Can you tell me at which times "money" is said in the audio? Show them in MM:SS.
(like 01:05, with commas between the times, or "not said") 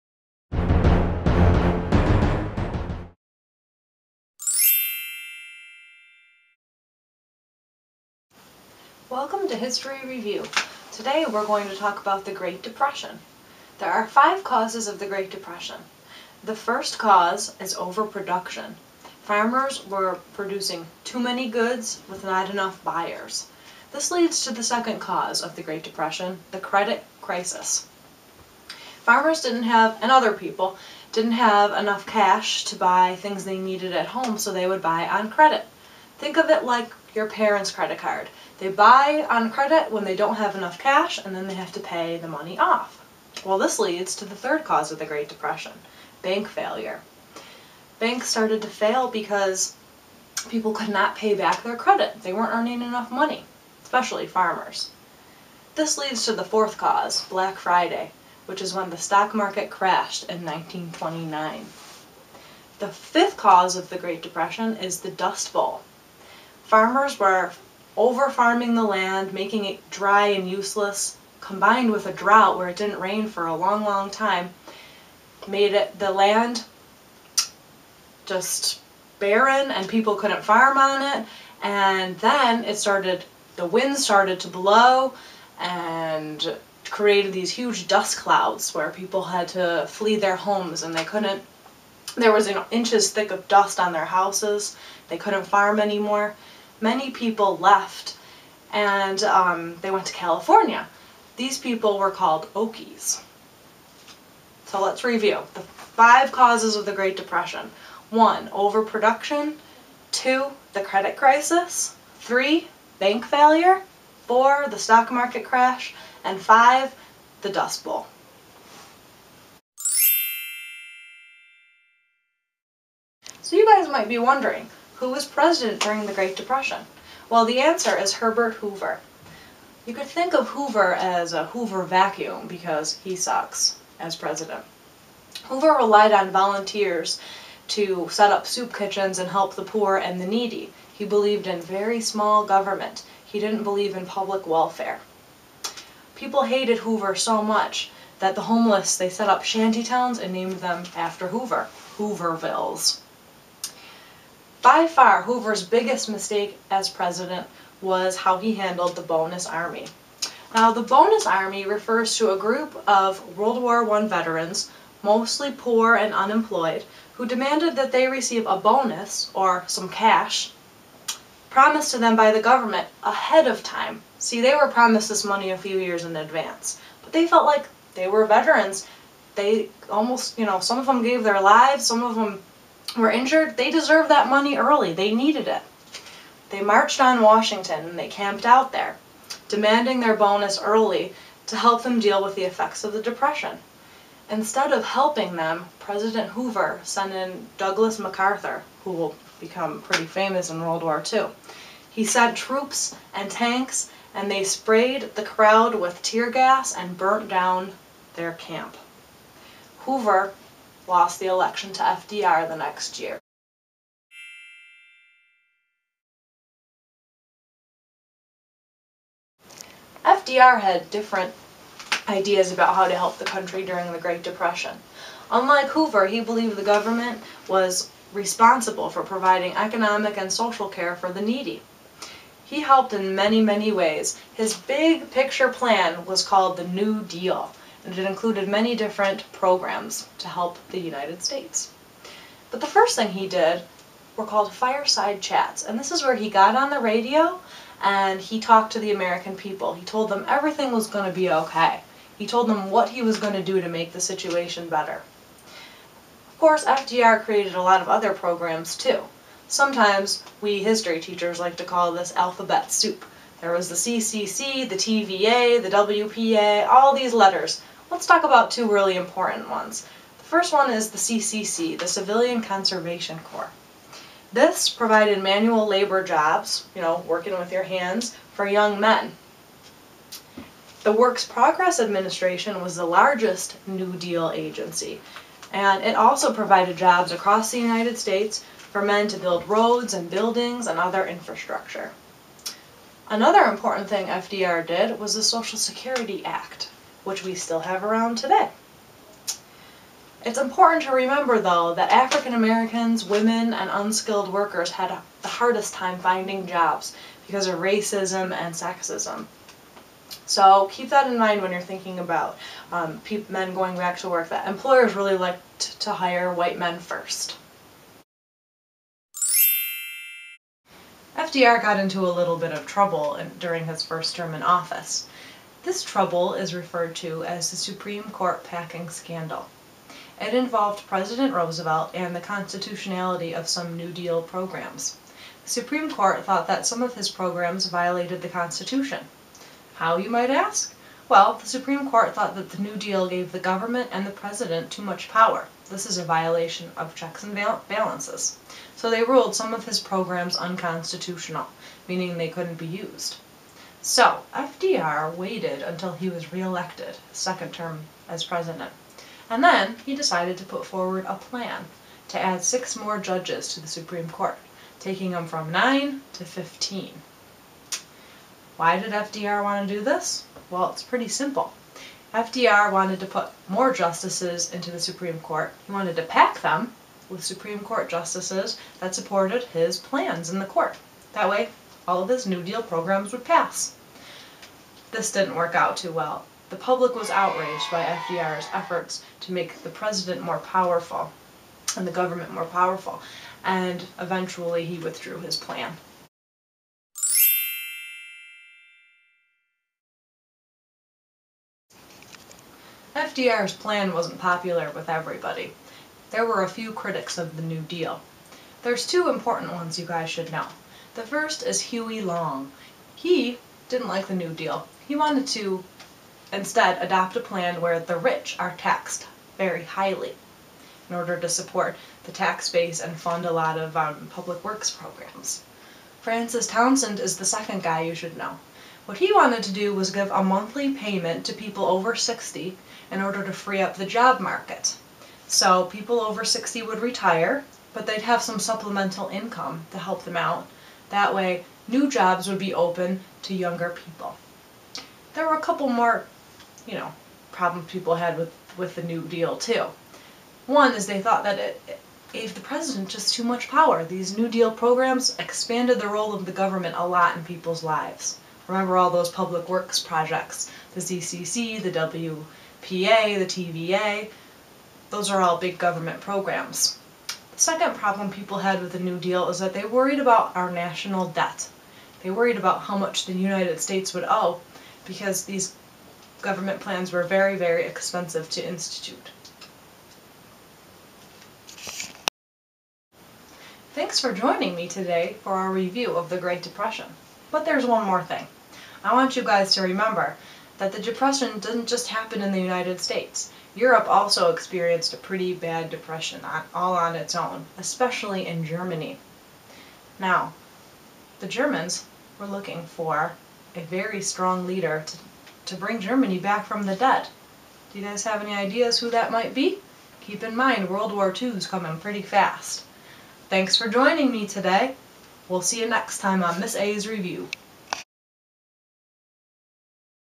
00:42, 00:53, 02:55, 03:04.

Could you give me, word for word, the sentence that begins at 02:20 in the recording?
He believed in very small government.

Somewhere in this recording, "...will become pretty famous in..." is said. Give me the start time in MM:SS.
03:18.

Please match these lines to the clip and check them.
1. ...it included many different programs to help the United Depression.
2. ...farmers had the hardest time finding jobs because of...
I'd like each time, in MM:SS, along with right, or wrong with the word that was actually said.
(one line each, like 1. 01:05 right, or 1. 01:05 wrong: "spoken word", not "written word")
1. 03:57 wrong: "States", not "Depression"
2. 05:04 wrong: "workers", not "farmers".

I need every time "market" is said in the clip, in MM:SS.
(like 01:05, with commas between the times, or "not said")
00:59, 01:55, 07:14.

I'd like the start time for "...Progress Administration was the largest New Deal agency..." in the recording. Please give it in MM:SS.
04:41.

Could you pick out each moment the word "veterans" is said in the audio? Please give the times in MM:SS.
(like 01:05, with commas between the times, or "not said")
02:44, 02:58.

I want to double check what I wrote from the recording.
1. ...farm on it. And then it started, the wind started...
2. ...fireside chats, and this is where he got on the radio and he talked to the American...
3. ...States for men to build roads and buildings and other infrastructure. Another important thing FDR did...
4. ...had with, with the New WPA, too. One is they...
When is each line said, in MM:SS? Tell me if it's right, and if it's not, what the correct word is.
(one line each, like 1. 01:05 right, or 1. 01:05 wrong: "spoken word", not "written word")
1. 01:20 right
2. 04:04 right
3. 04:47 right
4. 07:27 wrong: "Deal", not "WPA".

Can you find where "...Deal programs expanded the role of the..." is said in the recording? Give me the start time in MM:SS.
07:34.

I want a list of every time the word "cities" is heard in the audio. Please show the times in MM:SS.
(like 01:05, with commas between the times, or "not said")
not said.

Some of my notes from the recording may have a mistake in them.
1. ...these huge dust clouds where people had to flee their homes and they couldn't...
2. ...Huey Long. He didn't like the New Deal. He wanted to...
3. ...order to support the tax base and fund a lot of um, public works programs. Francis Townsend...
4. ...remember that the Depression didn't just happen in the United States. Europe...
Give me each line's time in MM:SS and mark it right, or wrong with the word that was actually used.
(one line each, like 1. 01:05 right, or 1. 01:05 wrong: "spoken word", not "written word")
1. 01:27 right
2. 06:51 right
3. 07:00 right
4. 08:09 right.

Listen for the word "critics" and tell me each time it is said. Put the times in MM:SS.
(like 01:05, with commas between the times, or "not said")
06:46.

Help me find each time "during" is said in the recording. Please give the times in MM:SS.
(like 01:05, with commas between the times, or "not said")
02:05, 03:43, 05:23.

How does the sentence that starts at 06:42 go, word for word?
FDR's plan wasn't popular with everybody.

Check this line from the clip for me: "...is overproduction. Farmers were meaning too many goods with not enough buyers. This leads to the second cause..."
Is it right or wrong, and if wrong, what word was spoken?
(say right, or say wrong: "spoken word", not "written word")
wrong: "producing", not "meaning".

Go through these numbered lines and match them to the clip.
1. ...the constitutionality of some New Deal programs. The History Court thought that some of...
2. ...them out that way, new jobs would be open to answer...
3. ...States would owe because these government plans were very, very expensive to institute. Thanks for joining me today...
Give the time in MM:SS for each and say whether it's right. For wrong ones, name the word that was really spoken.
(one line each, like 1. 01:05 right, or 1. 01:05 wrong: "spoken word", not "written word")
1. 05:32 wrong: "Supreme", not "History"
2. 07:20 wrong: "younger", not "answer"
3. 07:53 right.